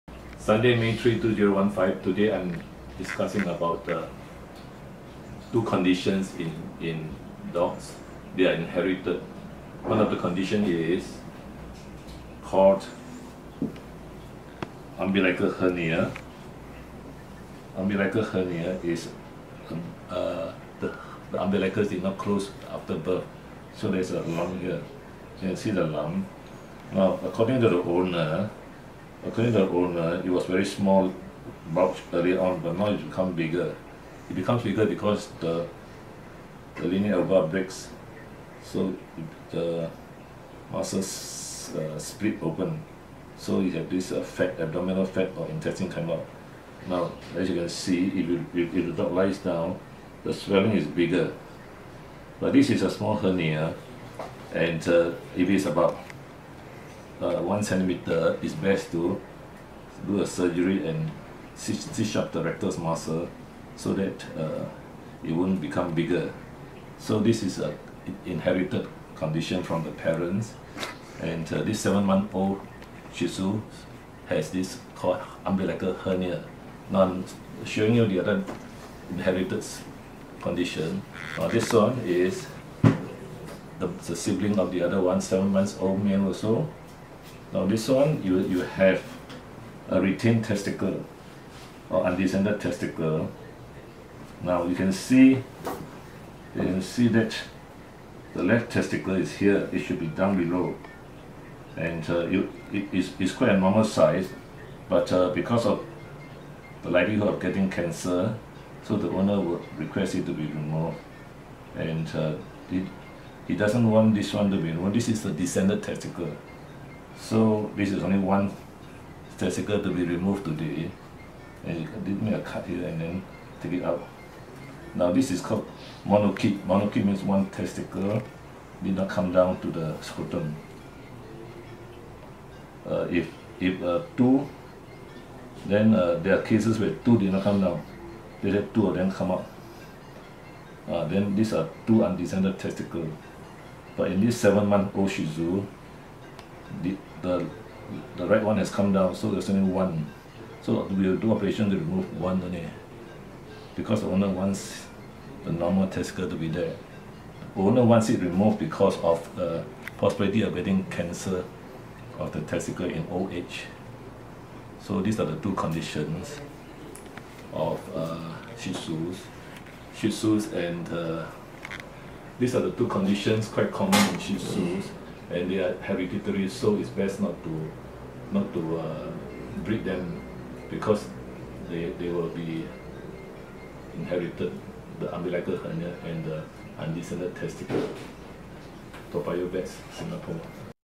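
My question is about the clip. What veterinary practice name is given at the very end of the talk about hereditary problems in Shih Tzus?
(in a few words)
Toa Vets.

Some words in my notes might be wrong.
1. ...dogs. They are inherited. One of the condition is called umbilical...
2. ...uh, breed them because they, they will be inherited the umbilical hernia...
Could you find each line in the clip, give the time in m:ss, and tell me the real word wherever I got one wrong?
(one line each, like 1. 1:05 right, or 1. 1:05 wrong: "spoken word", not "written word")
1. 0:07 right
2. 2:58 right.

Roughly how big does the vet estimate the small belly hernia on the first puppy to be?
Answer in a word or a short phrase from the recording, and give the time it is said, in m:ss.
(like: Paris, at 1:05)
1 centimeter, at 0:57.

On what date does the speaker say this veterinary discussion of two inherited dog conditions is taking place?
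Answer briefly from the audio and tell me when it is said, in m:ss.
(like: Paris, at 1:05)
Sunday, May 3, 2015, at 0:00.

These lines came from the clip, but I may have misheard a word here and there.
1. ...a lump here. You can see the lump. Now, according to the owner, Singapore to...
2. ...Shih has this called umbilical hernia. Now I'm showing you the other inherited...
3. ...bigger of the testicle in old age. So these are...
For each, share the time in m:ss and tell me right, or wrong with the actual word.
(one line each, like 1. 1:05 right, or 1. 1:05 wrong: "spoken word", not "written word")
1. 0:24 wrong: "According", not "Singapore"
2. 1:13 right
3. 2:40 wrong: "cancer", not "bigger".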